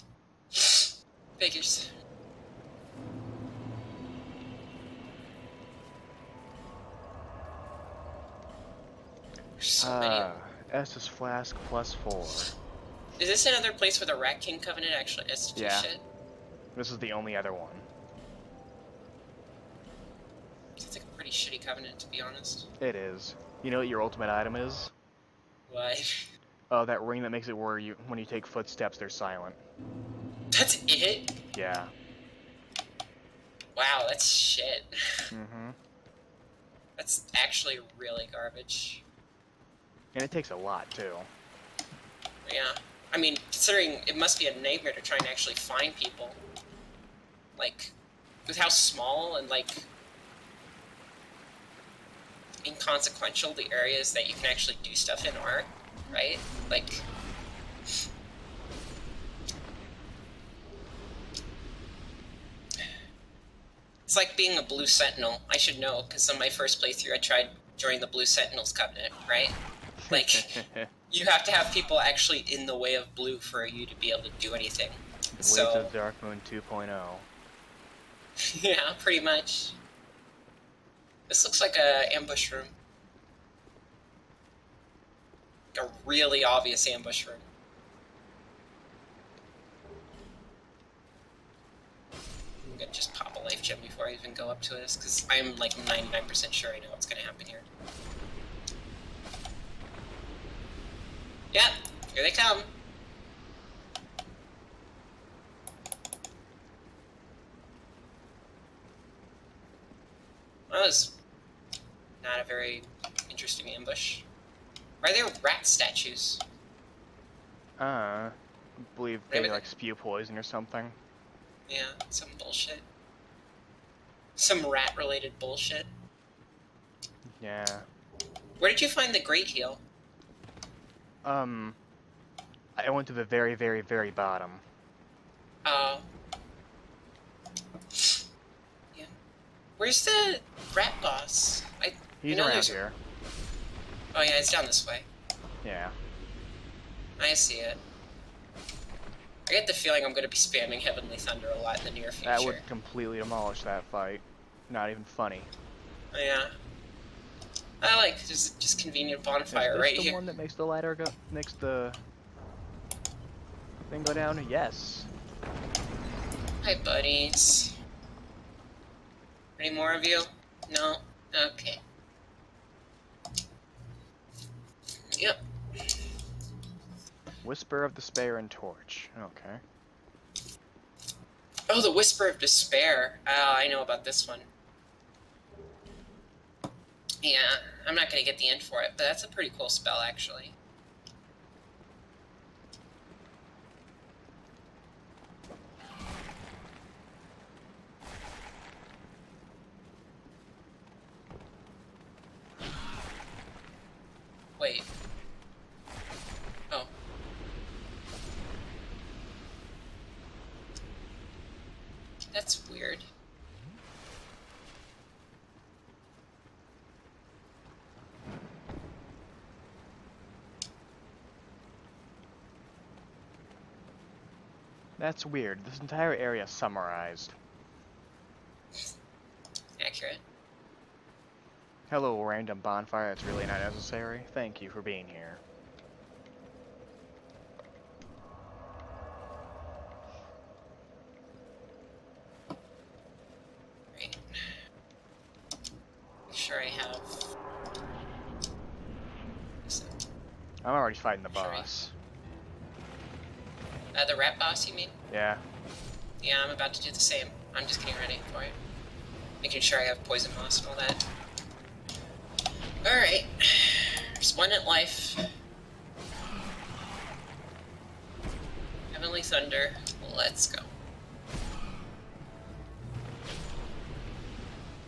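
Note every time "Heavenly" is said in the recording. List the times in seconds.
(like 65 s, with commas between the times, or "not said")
150 s, 268 s.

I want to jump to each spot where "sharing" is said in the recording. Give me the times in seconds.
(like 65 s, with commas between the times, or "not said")
not said.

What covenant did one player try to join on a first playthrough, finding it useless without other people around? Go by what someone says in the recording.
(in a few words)
Blue Sentinels.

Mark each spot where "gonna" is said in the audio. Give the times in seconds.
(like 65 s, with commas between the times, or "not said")
92 s, 97 s.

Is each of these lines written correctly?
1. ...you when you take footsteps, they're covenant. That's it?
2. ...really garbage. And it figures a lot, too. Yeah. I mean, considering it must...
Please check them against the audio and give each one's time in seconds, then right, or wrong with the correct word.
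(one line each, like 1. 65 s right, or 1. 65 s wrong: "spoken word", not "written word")
1. 27 s wrong: "silent", not "covenant"
2. 37 s wrong: "takes", not "figures".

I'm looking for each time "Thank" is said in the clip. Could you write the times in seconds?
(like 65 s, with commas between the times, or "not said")
234 s.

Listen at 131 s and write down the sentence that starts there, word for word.
Um, I went to the very, very, very bottom.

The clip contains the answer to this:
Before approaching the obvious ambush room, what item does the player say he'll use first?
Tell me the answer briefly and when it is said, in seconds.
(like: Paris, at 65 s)
life gem, at 93 s.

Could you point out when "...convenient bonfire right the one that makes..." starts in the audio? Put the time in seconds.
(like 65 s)
158 s.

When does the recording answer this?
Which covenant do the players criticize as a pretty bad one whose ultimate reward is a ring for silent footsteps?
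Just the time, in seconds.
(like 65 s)
14 s.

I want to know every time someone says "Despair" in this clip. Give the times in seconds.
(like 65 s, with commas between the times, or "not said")
177 s, 182 s.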